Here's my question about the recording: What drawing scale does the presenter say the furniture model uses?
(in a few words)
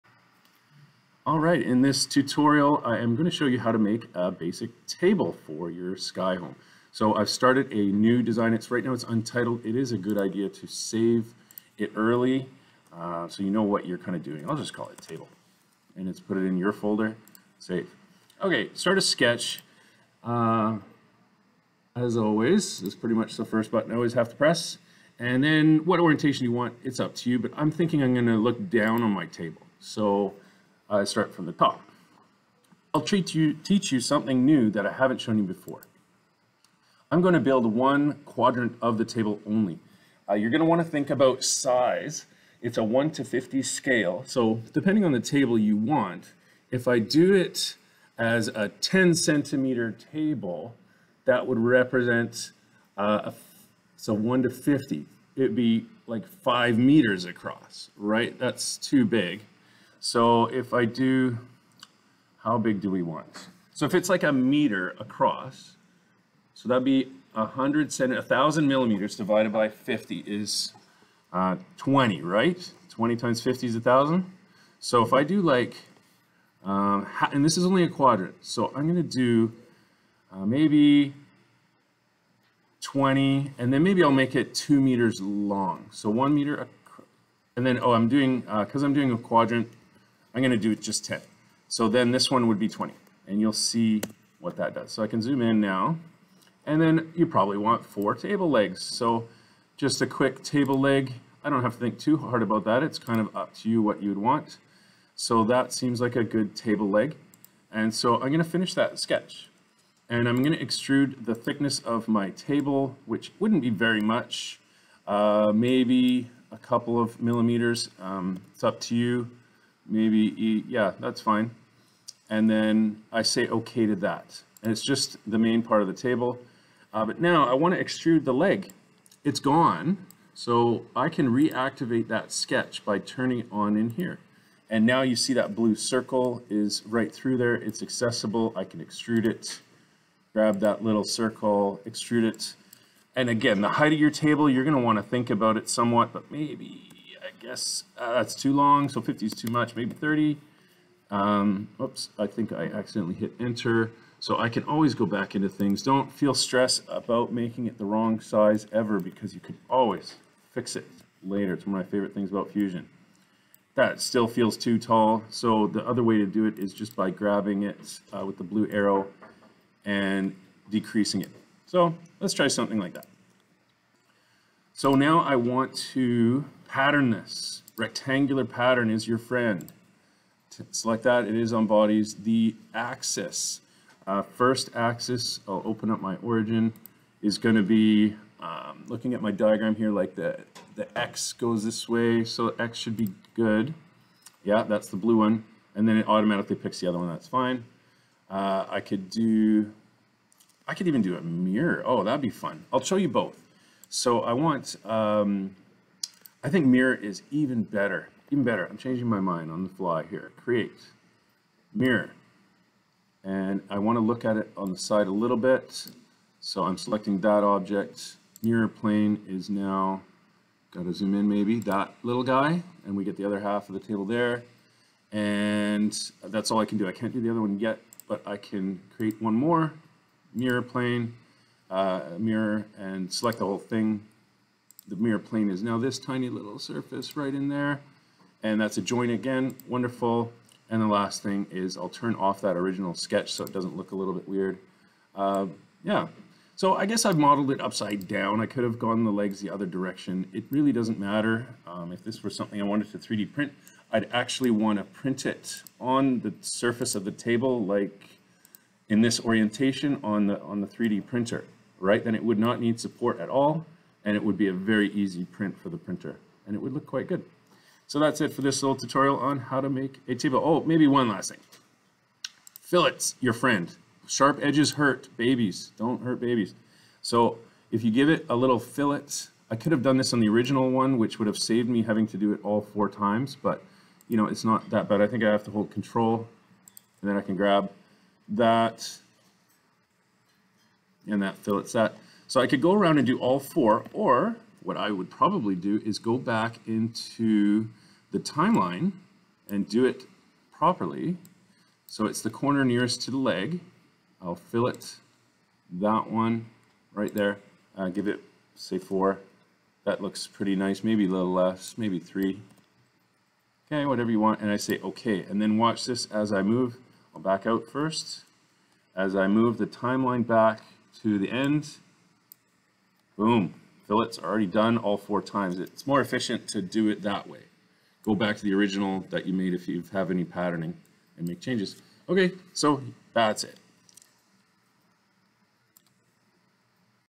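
1 to 50.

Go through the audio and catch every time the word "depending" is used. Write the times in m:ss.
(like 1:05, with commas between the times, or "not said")
0:44.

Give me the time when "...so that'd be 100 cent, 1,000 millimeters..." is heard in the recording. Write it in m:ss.
1:06.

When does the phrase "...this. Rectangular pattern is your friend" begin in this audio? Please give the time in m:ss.
2:57.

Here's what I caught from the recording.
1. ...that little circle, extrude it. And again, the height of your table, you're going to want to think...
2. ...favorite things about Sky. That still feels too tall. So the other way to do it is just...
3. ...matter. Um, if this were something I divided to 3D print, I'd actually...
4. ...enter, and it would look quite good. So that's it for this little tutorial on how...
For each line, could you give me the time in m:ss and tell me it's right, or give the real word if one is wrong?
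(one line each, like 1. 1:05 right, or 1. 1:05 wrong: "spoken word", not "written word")
1. 2:20 right
2. 2:41 wrong: "Fusion", not "Sky"
3. 4:10 wrong: "wanted", not "divided"
4. 4:25 wrong: "printer", not "enter".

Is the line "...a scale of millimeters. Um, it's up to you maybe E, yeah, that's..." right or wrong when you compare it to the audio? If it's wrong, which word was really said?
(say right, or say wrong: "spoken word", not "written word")
wrong: "couple", not "scale".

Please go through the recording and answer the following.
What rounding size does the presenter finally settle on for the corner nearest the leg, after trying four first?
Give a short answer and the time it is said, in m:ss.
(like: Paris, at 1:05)
3, at 5:11.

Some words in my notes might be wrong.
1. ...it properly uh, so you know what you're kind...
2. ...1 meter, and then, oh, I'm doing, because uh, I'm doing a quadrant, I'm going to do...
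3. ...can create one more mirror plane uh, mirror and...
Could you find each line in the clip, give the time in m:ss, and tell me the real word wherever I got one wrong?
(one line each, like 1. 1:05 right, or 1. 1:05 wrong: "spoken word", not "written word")
1. 0:11 wrong: "early", not "properly"
2. 1:26 right
3. 3:48 right.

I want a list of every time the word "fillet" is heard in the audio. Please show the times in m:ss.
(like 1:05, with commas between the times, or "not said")
4:32, 4:38, 4:51, 5:04, 5:23.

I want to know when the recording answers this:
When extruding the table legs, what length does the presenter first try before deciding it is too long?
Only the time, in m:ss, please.
2:28.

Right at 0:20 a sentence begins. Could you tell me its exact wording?
Uh, as always, this is pretty much the first button I always have to press.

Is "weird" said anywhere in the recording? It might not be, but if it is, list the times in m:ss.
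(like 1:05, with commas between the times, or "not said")
4:04.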